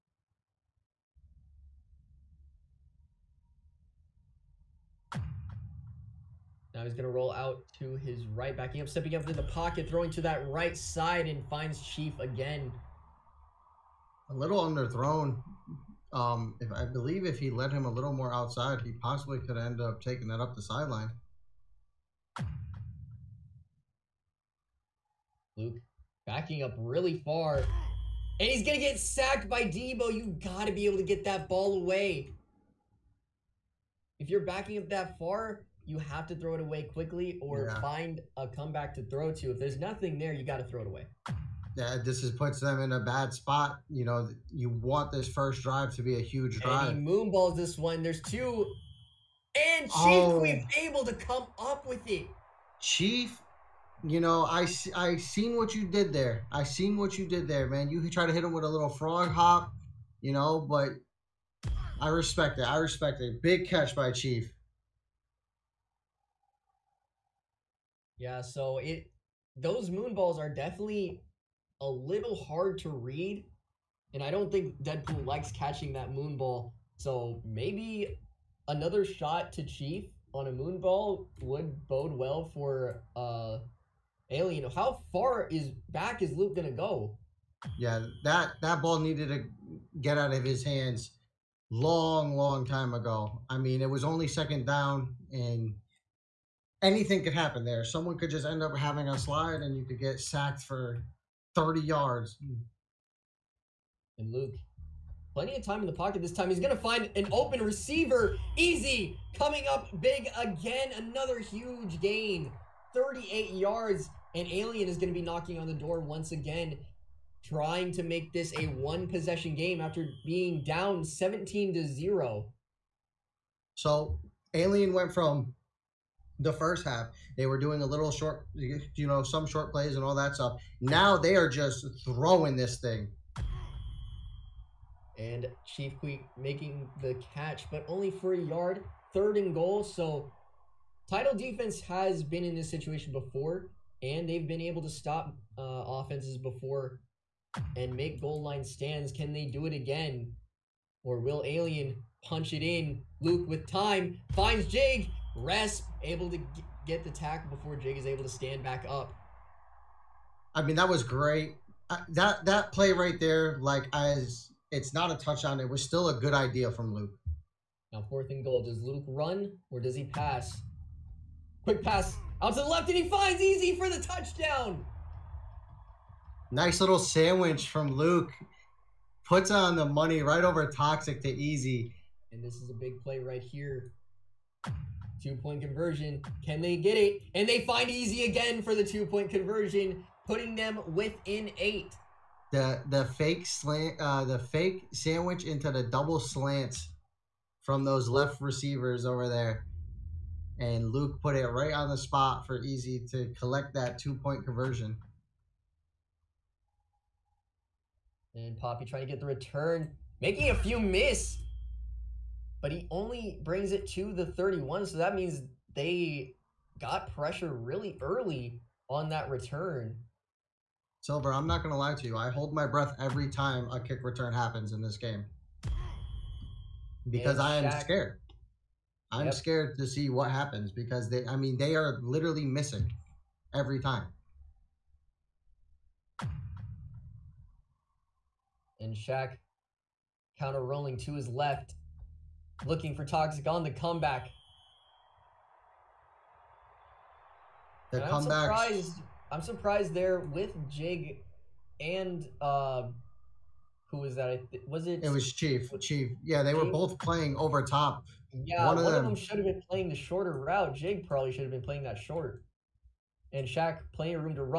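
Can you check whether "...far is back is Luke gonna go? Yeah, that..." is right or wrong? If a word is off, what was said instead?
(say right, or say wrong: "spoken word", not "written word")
right.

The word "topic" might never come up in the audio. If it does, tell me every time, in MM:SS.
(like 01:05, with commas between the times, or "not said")
not said.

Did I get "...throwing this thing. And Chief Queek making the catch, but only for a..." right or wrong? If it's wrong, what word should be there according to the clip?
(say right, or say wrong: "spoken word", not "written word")
right.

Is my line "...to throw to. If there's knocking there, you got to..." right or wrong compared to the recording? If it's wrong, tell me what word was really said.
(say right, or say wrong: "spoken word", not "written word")
wrong: "nothing", not "knocking".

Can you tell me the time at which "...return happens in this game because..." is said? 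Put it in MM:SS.
03:44.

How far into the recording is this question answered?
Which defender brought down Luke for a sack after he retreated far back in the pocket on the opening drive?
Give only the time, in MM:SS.
00:29.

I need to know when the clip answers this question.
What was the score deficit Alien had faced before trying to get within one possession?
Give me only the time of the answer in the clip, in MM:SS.
02:01.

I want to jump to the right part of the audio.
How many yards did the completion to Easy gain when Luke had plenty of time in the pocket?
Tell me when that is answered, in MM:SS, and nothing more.
01:52.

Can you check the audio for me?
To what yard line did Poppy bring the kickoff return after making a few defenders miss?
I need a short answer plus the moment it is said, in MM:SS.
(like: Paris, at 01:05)
31, at 03:34.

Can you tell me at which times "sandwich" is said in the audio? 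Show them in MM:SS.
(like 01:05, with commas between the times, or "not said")
02:56, 03:14.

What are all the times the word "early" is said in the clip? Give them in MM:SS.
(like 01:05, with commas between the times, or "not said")
03:38.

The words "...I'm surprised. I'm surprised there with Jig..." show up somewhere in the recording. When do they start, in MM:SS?
04:08.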